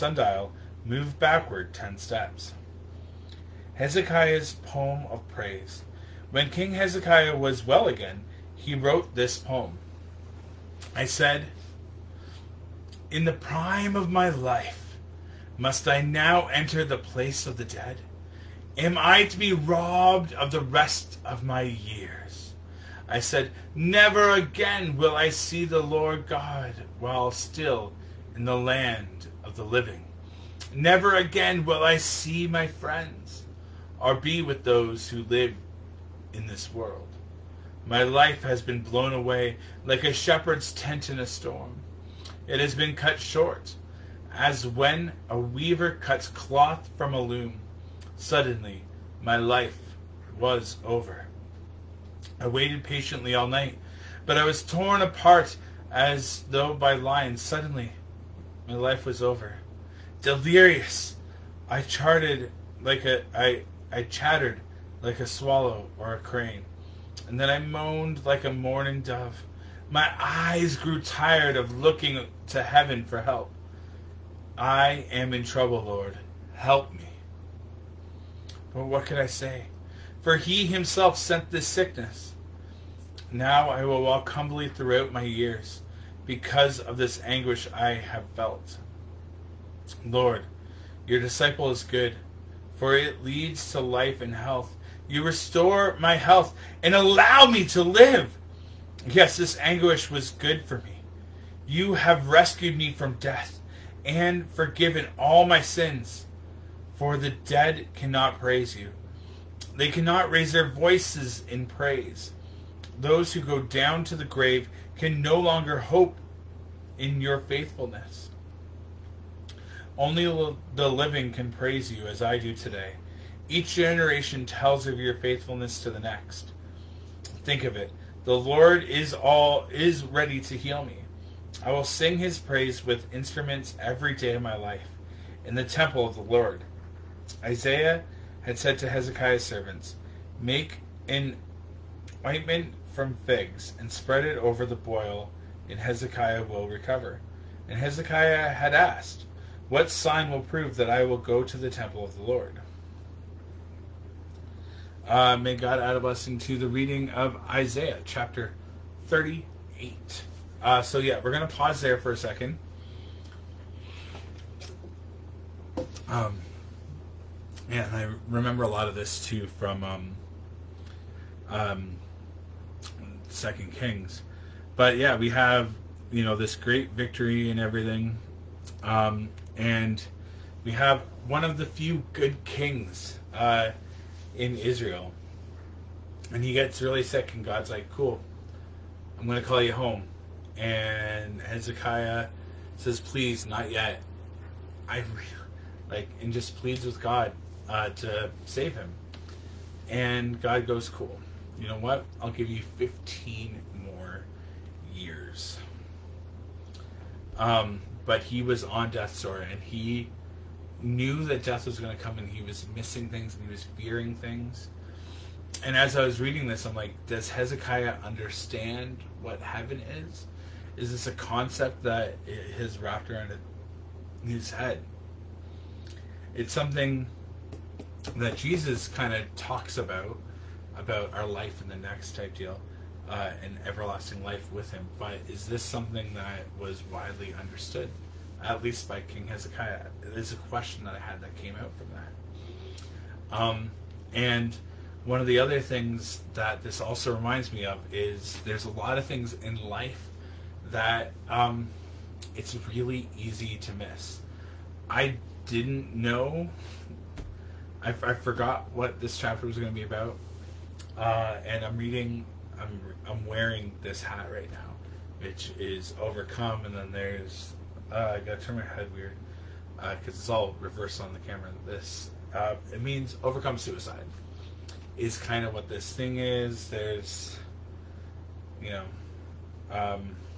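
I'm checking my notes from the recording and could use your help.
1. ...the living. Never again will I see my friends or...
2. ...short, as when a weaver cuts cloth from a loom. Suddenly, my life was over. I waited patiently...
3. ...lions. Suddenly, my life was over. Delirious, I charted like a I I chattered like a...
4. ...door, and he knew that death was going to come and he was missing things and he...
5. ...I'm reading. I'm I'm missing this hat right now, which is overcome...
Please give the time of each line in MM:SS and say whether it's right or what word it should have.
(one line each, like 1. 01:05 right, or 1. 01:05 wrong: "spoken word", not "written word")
1. 00:29 right
2. 00:43 right
3. 00:56 right
4. 03:29 right
5. 04:21 wrong: "wearing", not "missing".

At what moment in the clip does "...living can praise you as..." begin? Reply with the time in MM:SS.
02:00.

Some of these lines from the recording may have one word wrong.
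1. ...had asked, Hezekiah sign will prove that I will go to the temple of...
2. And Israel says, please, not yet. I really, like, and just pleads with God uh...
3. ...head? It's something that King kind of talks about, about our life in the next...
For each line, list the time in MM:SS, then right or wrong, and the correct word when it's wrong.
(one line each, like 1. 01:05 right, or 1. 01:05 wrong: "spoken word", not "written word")
1. 02:28 wrong: "What", not "Hezekiah"
2. 03:10 wrong: "Hezekiah", not "Israel"
3. 03:44 wrong: "Jesus", not "King".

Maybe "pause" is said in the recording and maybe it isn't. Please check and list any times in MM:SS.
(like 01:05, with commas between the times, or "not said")
02:41.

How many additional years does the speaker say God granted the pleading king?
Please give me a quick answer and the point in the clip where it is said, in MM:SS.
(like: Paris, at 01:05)
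15, at 03:22.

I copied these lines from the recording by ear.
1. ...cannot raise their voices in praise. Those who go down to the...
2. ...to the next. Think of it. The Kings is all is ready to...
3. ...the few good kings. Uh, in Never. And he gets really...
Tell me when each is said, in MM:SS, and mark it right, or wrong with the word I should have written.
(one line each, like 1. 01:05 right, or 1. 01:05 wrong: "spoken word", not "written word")
1. 01:49 right
2. 02:05 wrong: "Lord", not "Kings"
3. 03:01 wrong: "Israel", not "Never".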